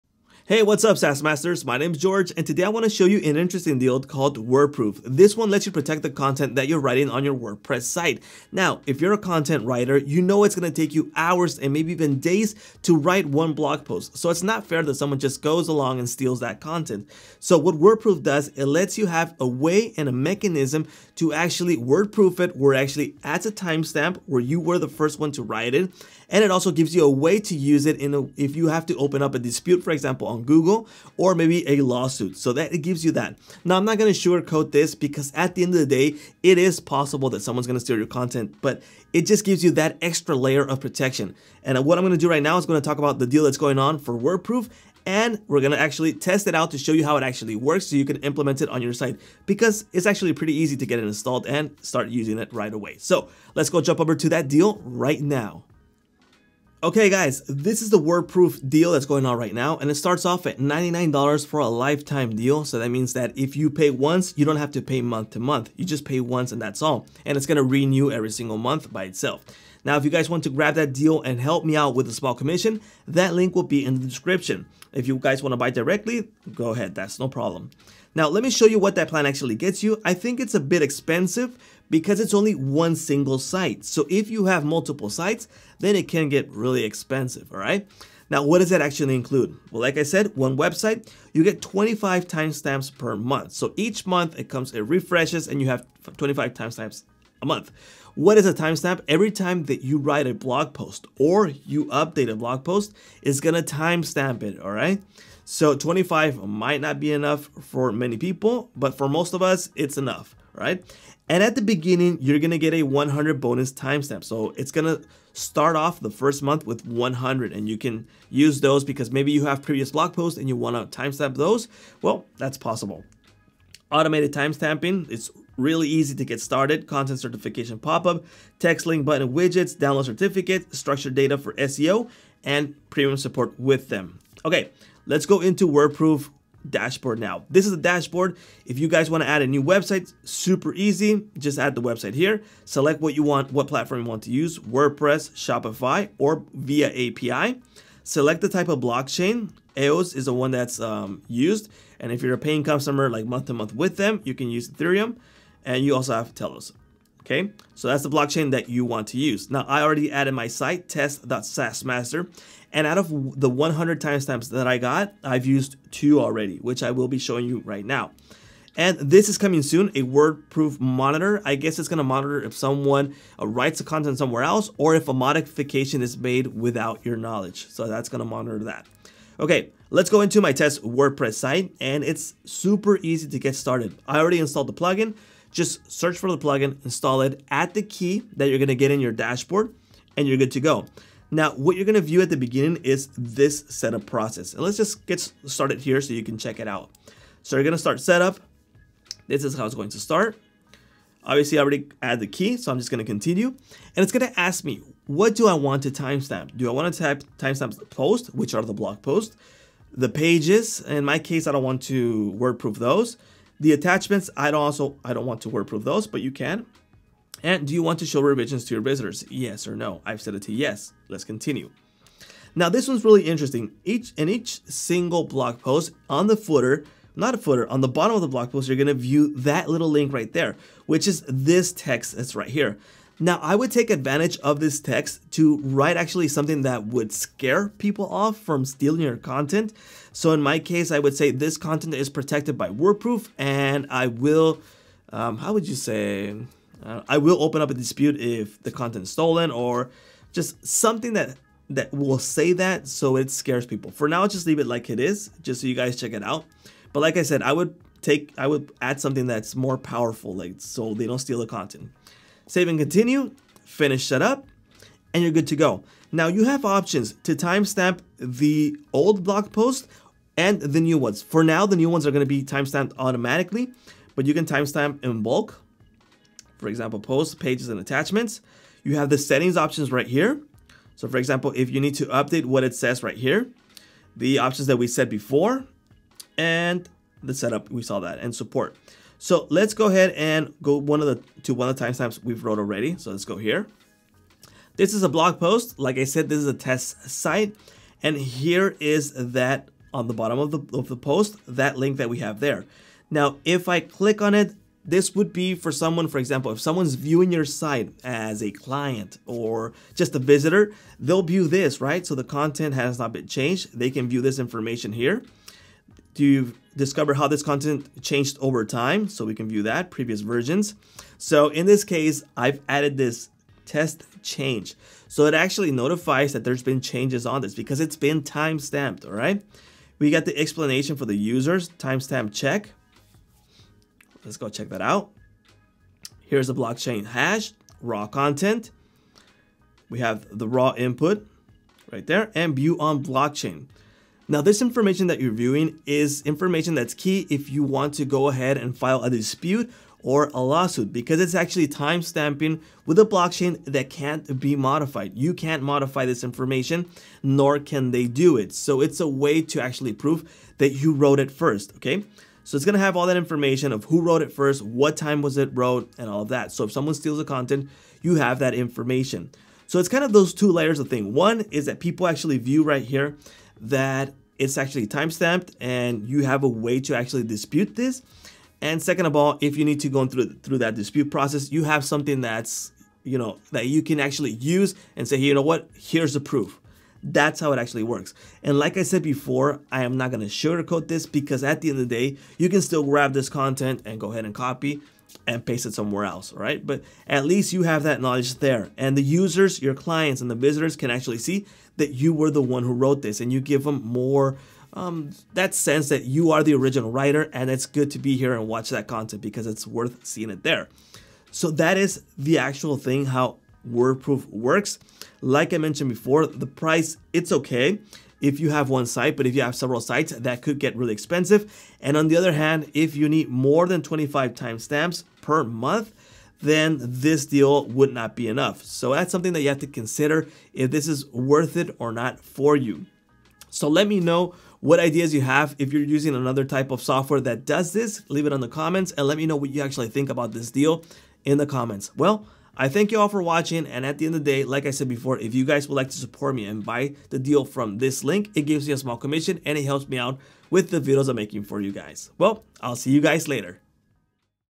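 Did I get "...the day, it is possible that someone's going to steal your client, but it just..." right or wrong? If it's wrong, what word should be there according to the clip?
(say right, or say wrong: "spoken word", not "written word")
wrong: "content", not "client".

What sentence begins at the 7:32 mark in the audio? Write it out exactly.
Well, I'll see you guys later.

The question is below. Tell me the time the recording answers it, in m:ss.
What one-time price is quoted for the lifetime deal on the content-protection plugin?
1:00.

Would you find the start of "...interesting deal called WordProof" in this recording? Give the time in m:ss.
0:03.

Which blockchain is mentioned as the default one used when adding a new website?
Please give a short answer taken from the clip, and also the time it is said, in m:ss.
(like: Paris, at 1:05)
EOS, at 2:29.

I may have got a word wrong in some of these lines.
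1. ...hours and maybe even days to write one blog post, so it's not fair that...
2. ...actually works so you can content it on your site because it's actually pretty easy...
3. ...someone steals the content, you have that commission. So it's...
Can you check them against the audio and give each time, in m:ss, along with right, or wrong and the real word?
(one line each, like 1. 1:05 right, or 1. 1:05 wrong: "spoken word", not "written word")
1. 0:11 right
2. 0:47 wrong: "implement", not "content"
3. 6:06 wrong: "information", not "commission".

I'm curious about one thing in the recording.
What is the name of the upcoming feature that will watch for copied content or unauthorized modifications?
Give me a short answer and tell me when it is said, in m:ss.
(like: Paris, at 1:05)
WordProof monitor, at 2:50.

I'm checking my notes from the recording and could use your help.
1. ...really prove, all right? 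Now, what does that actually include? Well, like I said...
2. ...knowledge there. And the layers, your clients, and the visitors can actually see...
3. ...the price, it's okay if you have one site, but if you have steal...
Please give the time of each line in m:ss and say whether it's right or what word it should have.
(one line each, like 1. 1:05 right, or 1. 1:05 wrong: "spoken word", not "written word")
1. 1:26 wrong: "expensive", not "prove"
2. 6:38 wrong: "users", not "layers"
3. 6:56 wrong: "several", not "steal".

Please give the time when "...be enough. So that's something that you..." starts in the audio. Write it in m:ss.
7:08.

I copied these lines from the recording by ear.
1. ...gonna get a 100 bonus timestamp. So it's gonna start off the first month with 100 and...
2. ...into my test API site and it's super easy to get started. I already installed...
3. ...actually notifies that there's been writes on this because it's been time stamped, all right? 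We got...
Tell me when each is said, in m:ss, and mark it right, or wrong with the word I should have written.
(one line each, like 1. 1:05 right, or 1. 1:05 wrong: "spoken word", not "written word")
1. 1:52 right
2. 3:00 wrong: "WordPress", not "API"
3. 5:25 wrong: "changes", not "writes".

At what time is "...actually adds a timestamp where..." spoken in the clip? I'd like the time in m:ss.
0:22.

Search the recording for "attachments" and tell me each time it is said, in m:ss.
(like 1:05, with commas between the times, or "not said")
3:33, 4:37.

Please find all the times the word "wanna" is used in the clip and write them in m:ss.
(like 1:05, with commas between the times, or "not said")
2:00, 3:26.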